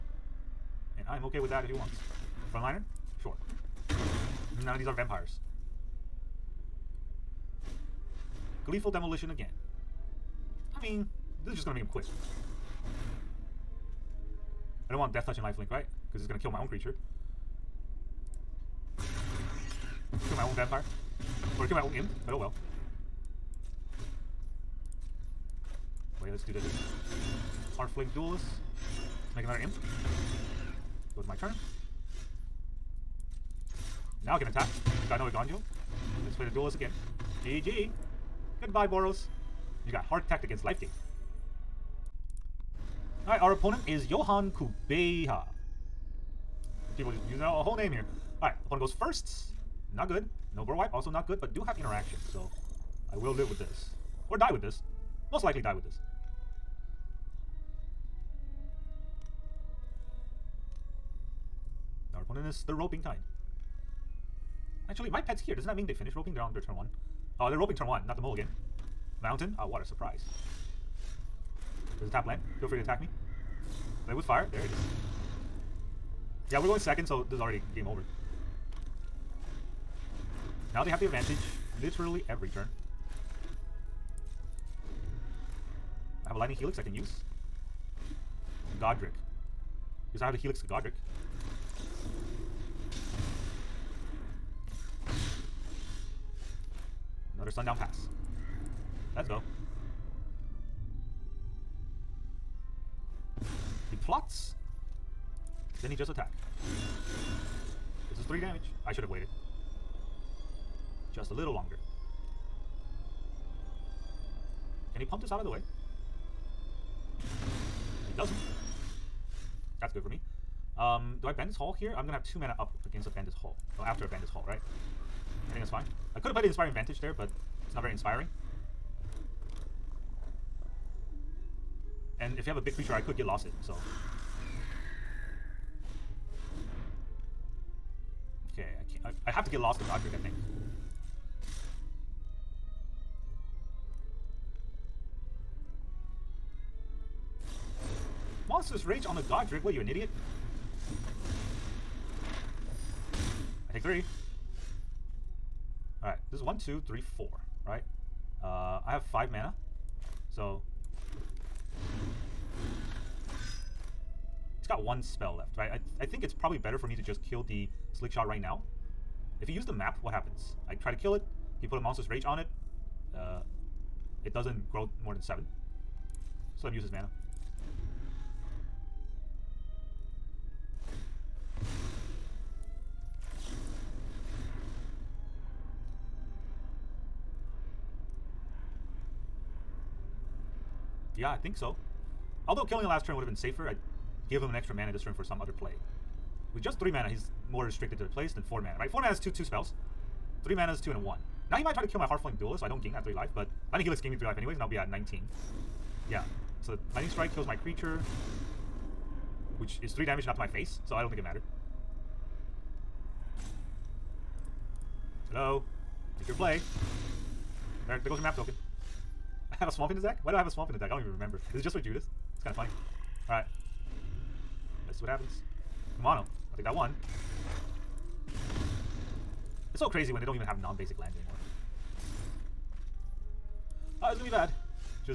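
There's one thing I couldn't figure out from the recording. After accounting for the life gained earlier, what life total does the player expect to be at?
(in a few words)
19.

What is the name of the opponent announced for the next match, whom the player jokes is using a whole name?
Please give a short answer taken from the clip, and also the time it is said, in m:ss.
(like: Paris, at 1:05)
Johan Kubeha, at 0:44.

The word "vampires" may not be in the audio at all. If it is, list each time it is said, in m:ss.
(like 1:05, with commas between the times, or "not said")
0:04, 0:20.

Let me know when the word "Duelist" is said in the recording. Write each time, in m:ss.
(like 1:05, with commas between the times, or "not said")
0:28, 0:36, 3:22.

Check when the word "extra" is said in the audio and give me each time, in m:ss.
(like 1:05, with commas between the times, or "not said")
3:14.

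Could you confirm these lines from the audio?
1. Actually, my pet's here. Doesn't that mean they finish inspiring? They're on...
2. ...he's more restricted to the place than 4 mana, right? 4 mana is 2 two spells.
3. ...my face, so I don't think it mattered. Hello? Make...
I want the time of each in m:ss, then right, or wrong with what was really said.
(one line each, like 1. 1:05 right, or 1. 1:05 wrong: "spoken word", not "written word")
1. 1:04 wrong: "roping", not "inspiring"
2. 3:17 right
3. 3:30 right.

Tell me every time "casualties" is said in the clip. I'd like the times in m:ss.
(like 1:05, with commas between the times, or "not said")
not said.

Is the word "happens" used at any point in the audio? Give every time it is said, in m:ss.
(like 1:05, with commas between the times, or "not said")
2:50, 3:45.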